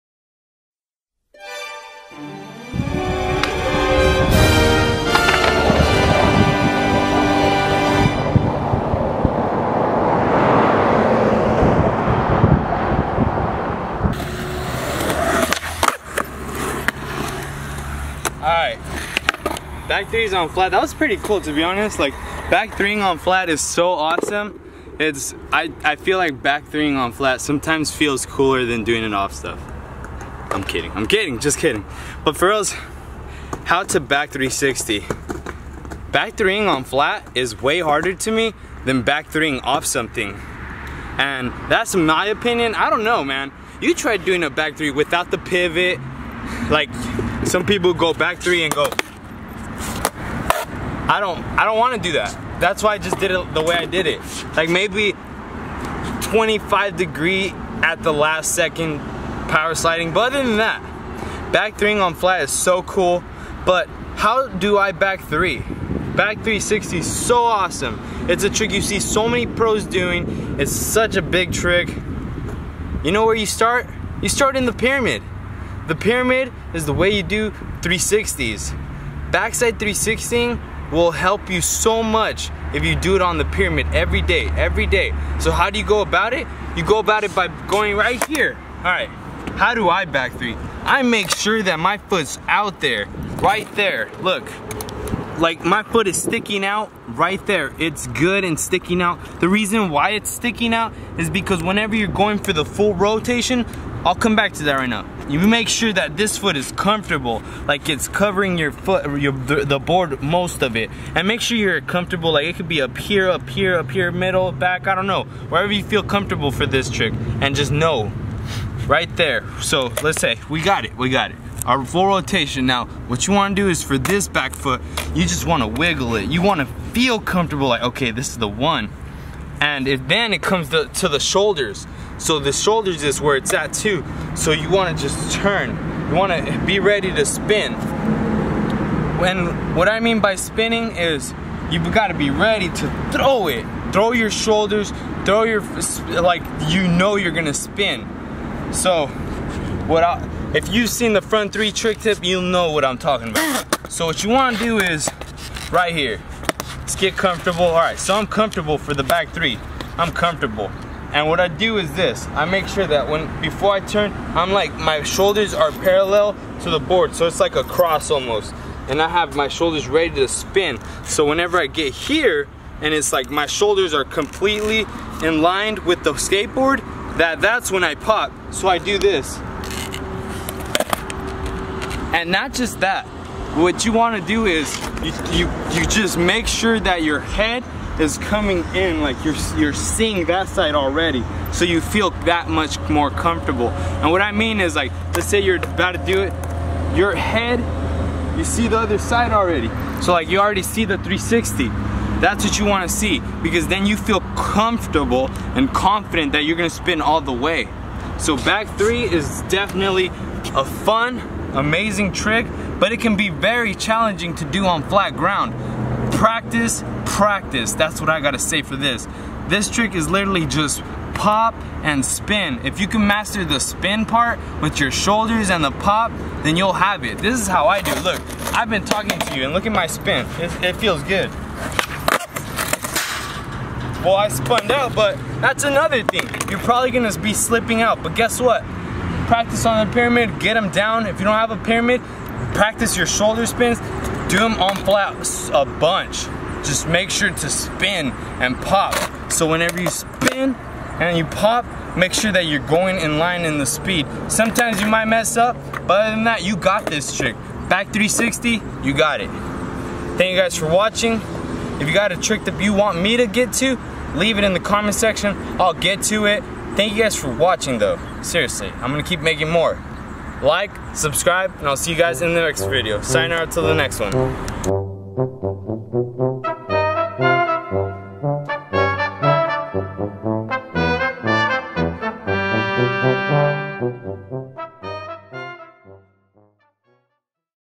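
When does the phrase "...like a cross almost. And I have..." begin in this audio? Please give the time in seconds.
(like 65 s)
167 s.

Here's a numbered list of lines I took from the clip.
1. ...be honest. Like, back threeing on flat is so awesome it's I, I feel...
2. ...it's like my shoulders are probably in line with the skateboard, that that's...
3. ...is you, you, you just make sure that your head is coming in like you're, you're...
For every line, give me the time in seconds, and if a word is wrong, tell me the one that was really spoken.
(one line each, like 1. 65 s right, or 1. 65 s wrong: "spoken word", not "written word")
1. 21 s right
2. 172 s wrong: "completely", not "probably"
3. 184 s right.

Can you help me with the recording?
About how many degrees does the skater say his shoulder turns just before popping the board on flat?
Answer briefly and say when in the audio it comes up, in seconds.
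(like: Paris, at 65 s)
25 degrees, at 56 s.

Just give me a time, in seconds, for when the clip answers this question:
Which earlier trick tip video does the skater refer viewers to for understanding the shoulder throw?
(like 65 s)
151 s.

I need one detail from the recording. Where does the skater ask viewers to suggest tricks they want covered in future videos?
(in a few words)
The comment section.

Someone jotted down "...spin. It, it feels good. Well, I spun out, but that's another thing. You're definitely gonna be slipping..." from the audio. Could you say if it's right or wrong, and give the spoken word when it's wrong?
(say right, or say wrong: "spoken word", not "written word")
wrong: "probably", not "definitely".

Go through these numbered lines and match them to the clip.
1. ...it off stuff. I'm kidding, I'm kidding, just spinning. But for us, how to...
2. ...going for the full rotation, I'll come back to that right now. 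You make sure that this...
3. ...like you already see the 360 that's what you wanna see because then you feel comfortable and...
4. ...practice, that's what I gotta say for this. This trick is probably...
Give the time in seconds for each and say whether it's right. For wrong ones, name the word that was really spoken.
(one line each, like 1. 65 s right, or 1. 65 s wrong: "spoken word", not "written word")
1. 29 s wrong: "kidding", not "spinning"
2. 102 s right
3. 200 s right
4. 217 s wrong: "literally", not "probably".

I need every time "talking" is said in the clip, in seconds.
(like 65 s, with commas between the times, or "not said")
152 s, 228 s.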